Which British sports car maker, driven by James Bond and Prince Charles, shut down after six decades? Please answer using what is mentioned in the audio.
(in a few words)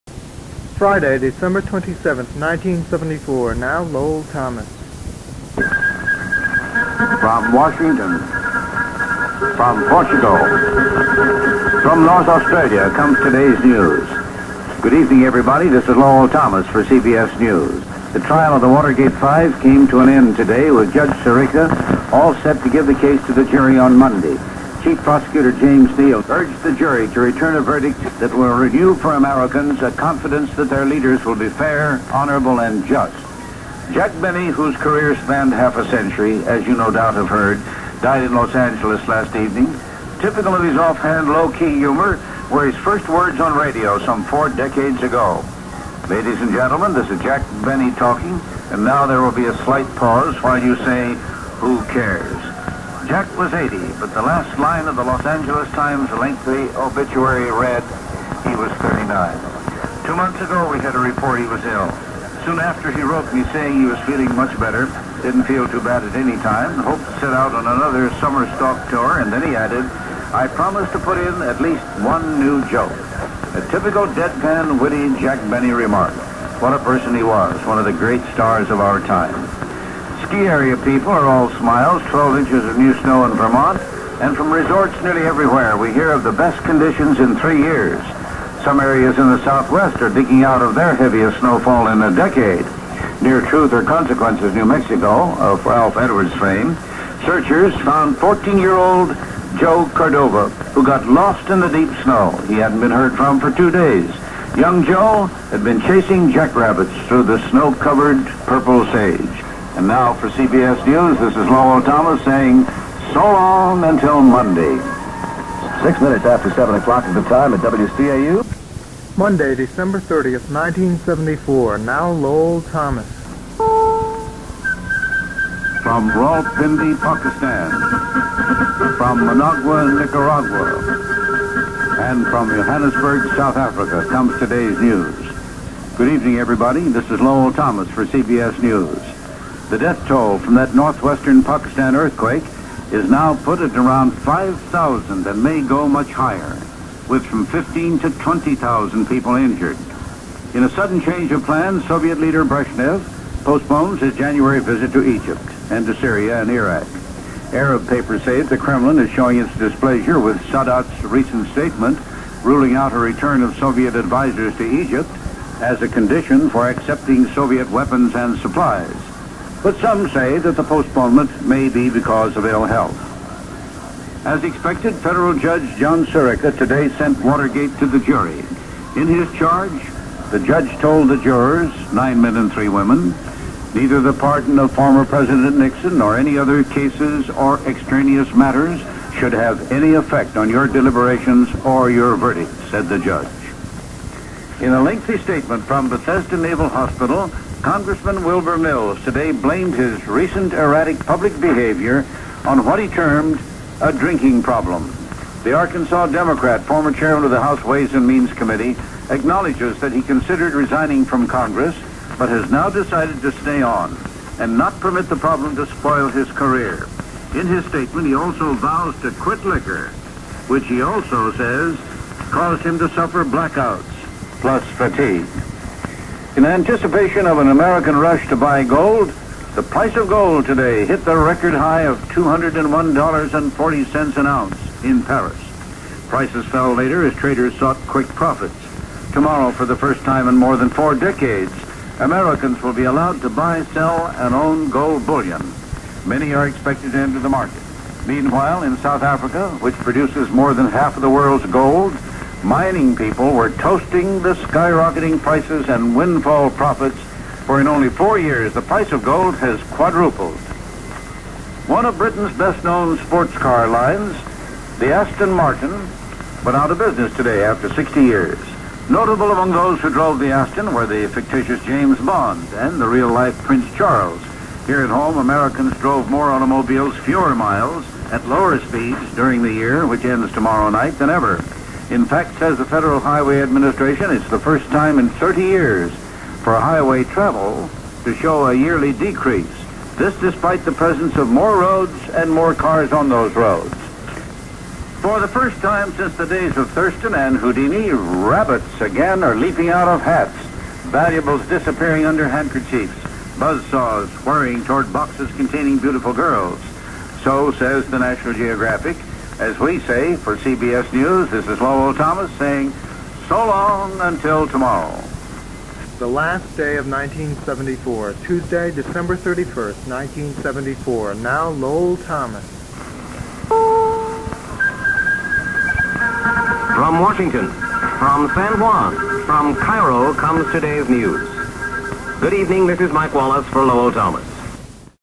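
Aston Martin.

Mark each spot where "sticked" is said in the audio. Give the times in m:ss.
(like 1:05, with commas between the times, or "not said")
not said.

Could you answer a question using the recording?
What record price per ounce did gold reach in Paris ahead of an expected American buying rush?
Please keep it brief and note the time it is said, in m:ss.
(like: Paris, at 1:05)
$201.40, at 3:52.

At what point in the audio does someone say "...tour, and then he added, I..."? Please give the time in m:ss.
1:08.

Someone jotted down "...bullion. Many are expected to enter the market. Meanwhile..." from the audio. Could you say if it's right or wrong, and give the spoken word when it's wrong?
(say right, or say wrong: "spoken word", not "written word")
right.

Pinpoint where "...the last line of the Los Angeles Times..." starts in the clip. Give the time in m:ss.
0:54.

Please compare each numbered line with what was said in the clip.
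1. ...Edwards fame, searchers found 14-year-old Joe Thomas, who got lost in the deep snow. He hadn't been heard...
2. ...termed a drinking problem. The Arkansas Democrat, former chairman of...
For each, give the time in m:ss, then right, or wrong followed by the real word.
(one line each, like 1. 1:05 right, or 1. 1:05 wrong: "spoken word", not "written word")
1. 1:35 wrong: "Cordova", not "Thomas"
2. 3:22 right.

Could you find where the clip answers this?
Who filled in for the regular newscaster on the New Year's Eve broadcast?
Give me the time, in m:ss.
5:32.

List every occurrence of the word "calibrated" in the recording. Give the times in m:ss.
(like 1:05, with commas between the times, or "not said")
not said.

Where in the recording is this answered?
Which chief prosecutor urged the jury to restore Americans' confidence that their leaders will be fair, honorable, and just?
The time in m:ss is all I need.
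0:25.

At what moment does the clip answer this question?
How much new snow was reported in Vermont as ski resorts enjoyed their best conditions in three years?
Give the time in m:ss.
1:22.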